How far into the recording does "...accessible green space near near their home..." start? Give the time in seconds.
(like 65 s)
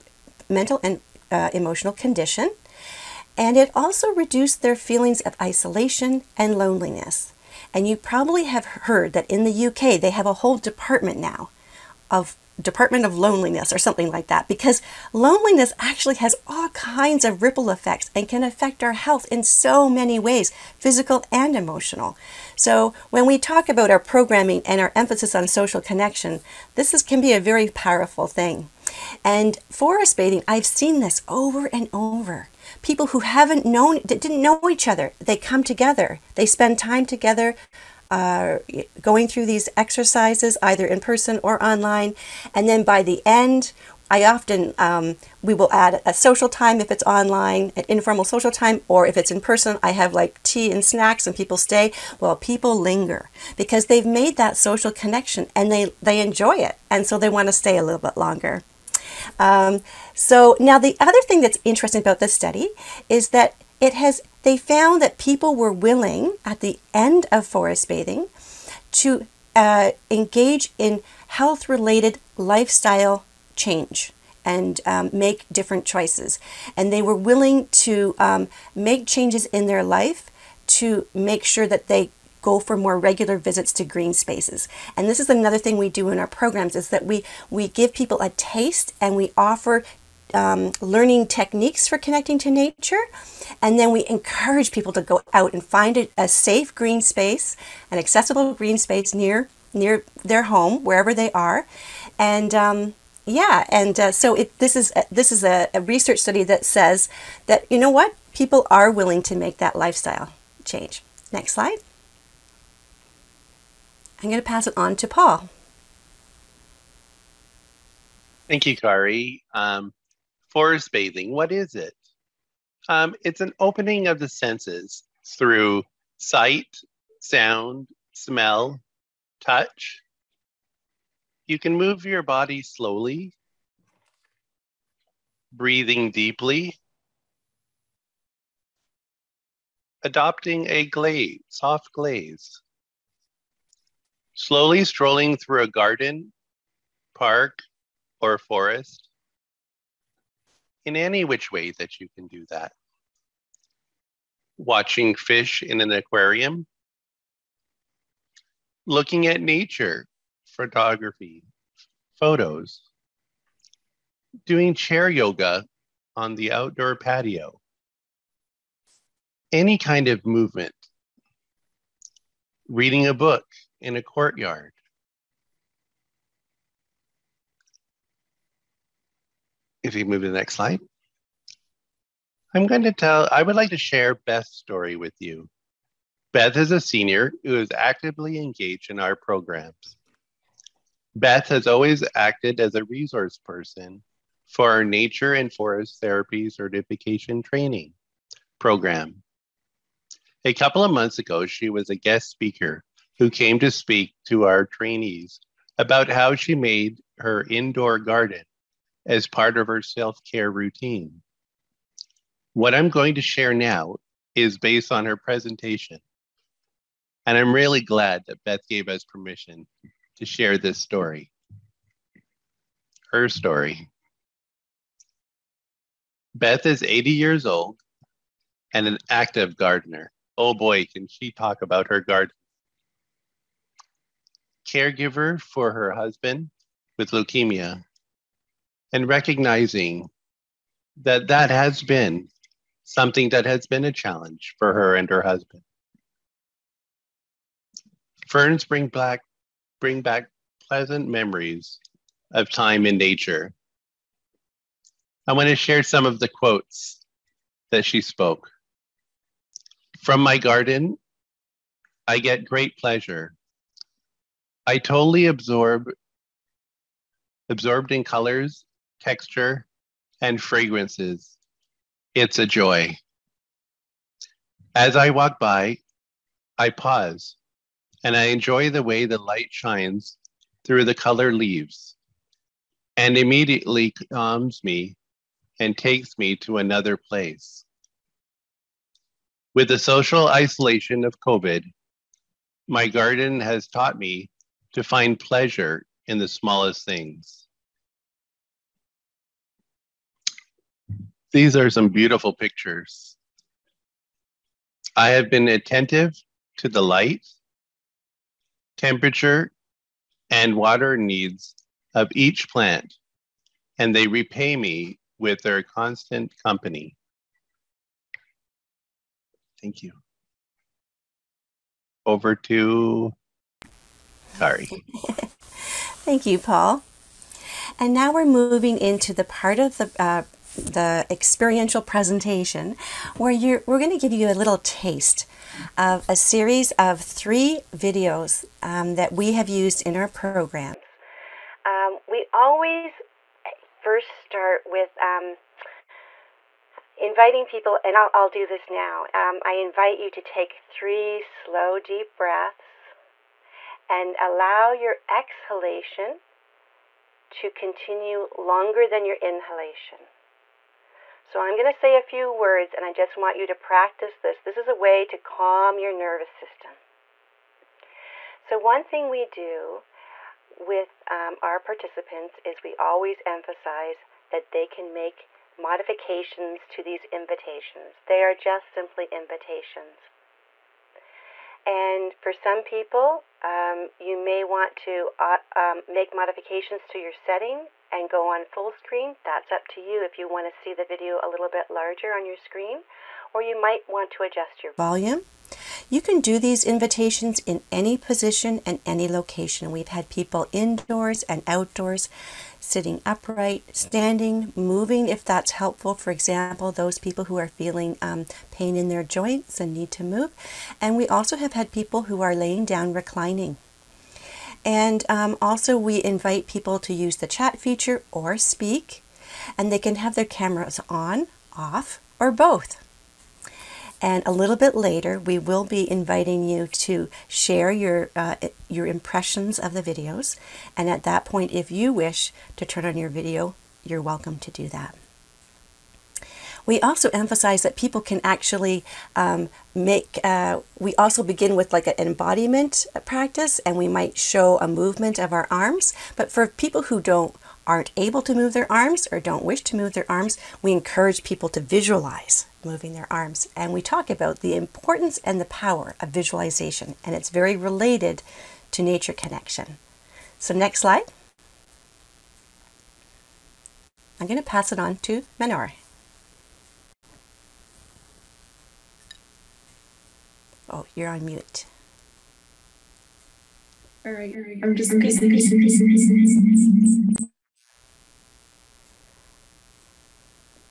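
97 s.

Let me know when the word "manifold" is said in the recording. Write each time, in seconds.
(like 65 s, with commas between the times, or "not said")
not said.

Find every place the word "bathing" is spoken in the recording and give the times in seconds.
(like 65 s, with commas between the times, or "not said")
30 s, 67 s, 120 s.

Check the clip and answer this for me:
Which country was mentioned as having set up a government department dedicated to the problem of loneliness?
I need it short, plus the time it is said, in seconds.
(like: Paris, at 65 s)
UK, at 9 s.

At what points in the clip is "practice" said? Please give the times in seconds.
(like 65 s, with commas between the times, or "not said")
363 s, 443 s.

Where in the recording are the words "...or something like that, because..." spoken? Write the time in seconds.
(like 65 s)
13 s.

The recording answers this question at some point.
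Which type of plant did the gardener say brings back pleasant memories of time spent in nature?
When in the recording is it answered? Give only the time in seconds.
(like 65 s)
248 s.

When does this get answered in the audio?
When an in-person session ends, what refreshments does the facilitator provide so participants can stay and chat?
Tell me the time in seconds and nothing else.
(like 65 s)
50 s.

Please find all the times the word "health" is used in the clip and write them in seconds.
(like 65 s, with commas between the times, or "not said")
18 s, 71 s.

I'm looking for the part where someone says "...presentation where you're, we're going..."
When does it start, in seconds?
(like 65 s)
331 s.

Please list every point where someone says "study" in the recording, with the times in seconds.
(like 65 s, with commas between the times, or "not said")
62 s, 106 s.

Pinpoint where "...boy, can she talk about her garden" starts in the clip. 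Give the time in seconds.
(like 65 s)
230 s.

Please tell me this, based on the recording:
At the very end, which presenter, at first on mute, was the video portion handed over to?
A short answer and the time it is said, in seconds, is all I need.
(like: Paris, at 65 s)
Menore, at 465 s.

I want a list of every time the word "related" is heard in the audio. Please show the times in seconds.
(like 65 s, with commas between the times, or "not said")
71 s, 457 s.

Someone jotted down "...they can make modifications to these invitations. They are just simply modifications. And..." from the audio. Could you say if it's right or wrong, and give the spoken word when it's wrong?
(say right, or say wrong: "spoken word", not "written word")
wrong: "invitations", not "modifications".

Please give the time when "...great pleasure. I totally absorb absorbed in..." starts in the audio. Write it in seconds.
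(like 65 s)
262 s.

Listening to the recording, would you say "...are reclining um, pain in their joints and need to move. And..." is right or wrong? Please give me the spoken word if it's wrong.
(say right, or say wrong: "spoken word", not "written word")
wrong: "feeling", not "reclining".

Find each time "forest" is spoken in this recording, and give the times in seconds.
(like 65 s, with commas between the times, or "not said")
29 s, 67 s, 120 s, 148 s, 195 s.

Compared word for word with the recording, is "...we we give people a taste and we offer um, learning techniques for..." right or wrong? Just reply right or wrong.
right.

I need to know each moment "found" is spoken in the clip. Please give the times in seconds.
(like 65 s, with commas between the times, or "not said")
64 s.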